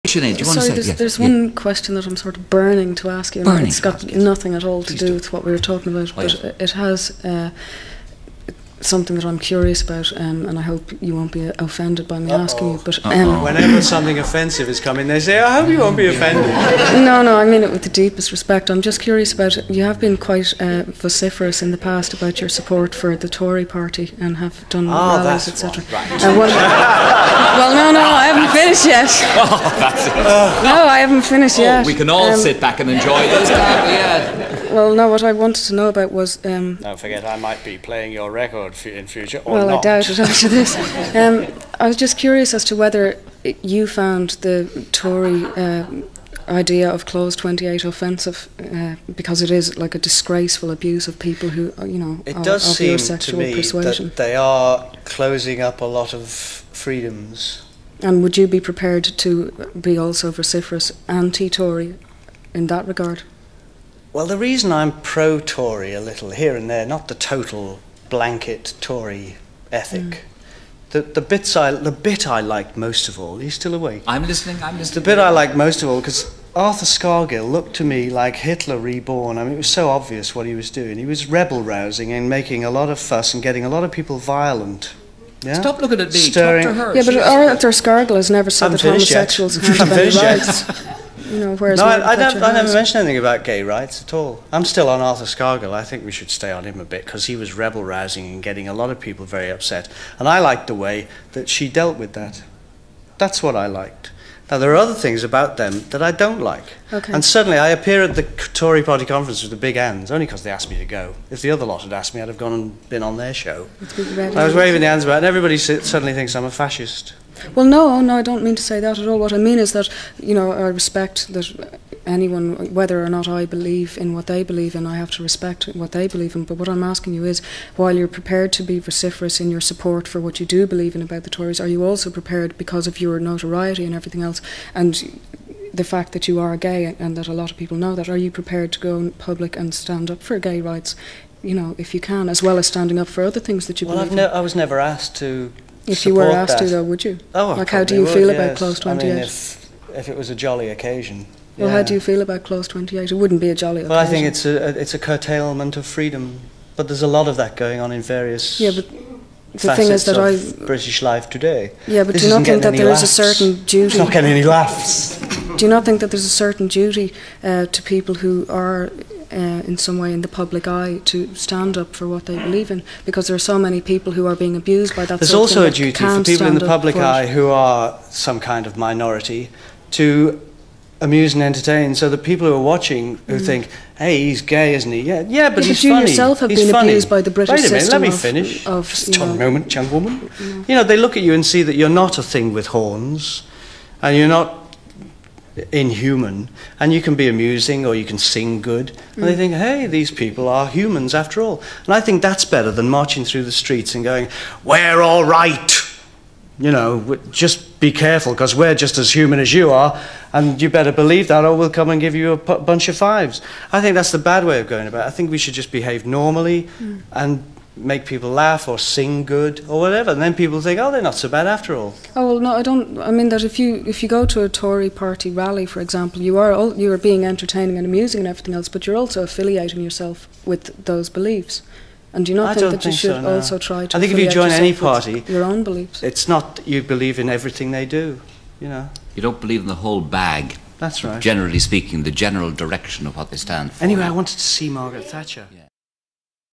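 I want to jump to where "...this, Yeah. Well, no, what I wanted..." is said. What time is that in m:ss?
0:33.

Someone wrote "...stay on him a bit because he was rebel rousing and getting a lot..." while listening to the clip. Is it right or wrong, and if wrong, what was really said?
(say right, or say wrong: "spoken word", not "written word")
right.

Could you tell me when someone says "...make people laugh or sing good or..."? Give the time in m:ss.
3:37.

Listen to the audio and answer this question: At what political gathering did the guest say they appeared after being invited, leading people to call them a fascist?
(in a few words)
Tory party conference.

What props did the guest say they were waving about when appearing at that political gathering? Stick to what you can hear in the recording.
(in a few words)
big hands.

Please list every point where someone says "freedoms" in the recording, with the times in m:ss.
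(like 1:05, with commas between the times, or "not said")
0:56, 2:35.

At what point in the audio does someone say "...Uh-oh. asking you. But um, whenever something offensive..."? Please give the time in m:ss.
0:12.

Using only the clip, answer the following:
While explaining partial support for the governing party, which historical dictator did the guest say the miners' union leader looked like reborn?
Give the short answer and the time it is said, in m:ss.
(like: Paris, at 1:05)
Hitler, at 1:18.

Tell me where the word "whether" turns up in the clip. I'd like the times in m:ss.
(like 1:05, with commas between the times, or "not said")
0:42, 2:02.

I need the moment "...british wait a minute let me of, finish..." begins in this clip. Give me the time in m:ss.
3:07.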